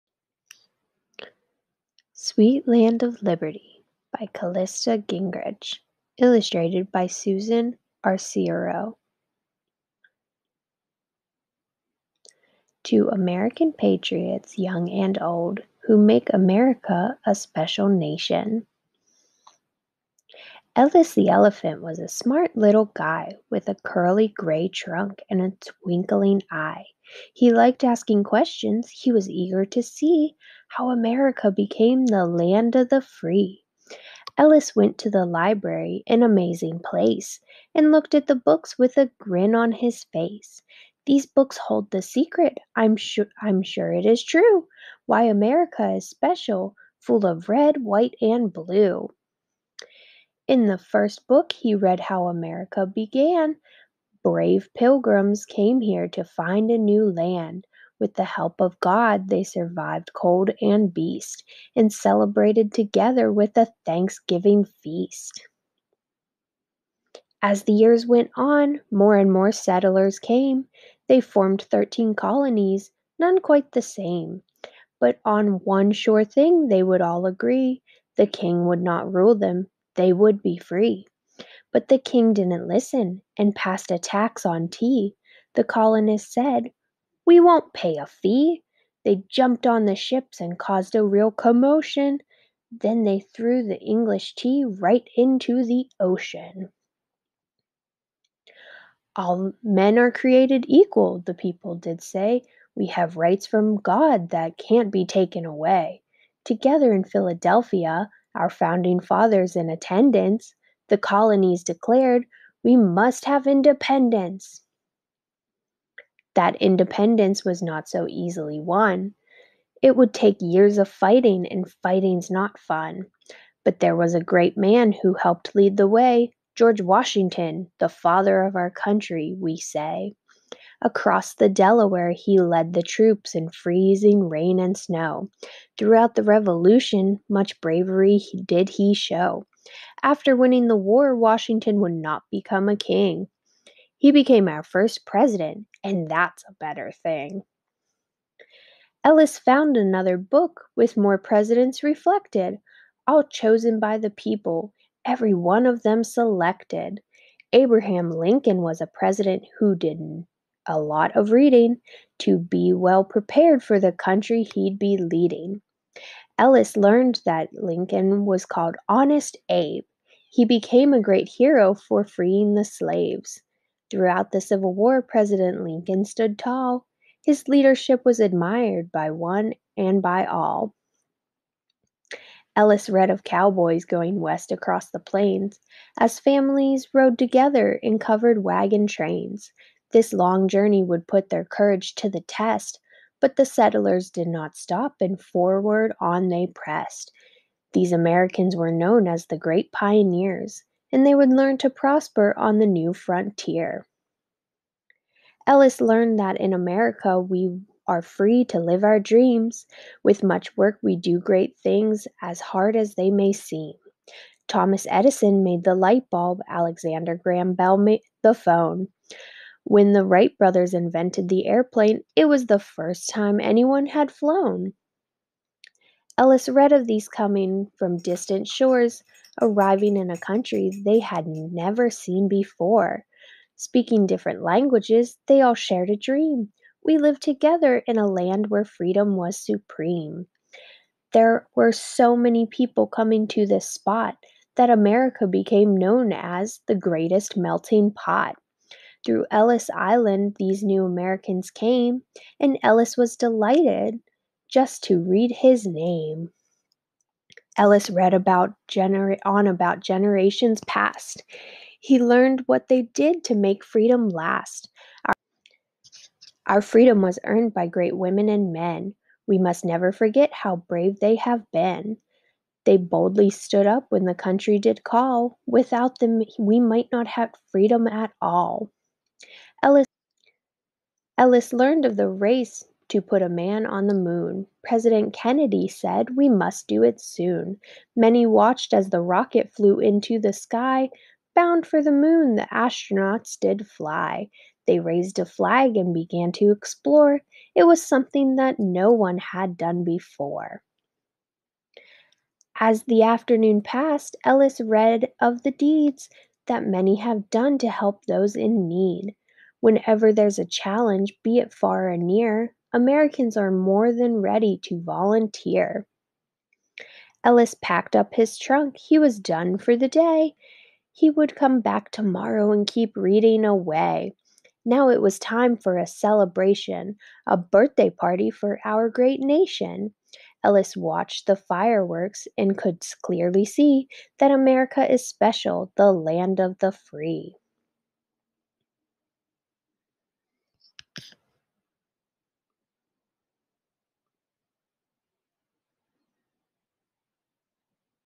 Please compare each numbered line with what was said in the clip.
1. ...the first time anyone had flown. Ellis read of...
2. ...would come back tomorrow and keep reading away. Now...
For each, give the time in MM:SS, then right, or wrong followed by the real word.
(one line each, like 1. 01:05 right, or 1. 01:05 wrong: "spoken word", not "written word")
1. 03:42 right
2. 05:21 right.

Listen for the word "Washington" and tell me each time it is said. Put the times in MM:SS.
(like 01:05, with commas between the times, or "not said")
02:06, 02:21.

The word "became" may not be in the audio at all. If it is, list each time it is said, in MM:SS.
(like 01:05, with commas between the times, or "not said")
00:31, 02:24, 02:50, 04:05.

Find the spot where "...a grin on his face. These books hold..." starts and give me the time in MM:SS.
00:38.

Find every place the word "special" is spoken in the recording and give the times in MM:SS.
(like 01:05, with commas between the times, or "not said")
00:17, 00:46, 05:35.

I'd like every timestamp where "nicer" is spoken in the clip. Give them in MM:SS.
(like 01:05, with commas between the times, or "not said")
not said.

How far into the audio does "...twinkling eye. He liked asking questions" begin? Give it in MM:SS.
00:25.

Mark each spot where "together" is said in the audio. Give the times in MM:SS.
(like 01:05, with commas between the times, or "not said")
01:02, 01:46, 03:07, 03:57.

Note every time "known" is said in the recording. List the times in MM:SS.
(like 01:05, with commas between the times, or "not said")
03:18, 04:05.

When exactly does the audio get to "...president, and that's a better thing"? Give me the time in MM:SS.
02:25.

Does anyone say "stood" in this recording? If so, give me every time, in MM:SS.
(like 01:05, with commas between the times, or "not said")
02:56, 04:33.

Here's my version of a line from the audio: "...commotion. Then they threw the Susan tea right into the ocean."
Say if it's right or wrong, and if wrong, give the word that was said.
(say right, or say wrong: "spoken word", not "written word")
wrong: "English", not "Susan".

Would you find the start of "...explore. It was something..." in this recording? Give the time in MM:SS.
04:56.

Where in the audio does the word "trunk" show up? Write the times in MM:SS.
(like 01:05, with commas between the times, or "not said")
00:24, 05:18.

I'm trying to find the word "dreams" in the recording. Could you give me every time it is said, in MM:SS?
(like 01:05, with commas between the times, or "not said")
03:28, 03:55.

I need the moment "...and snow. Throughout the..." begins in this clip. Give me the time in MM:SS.
02:14.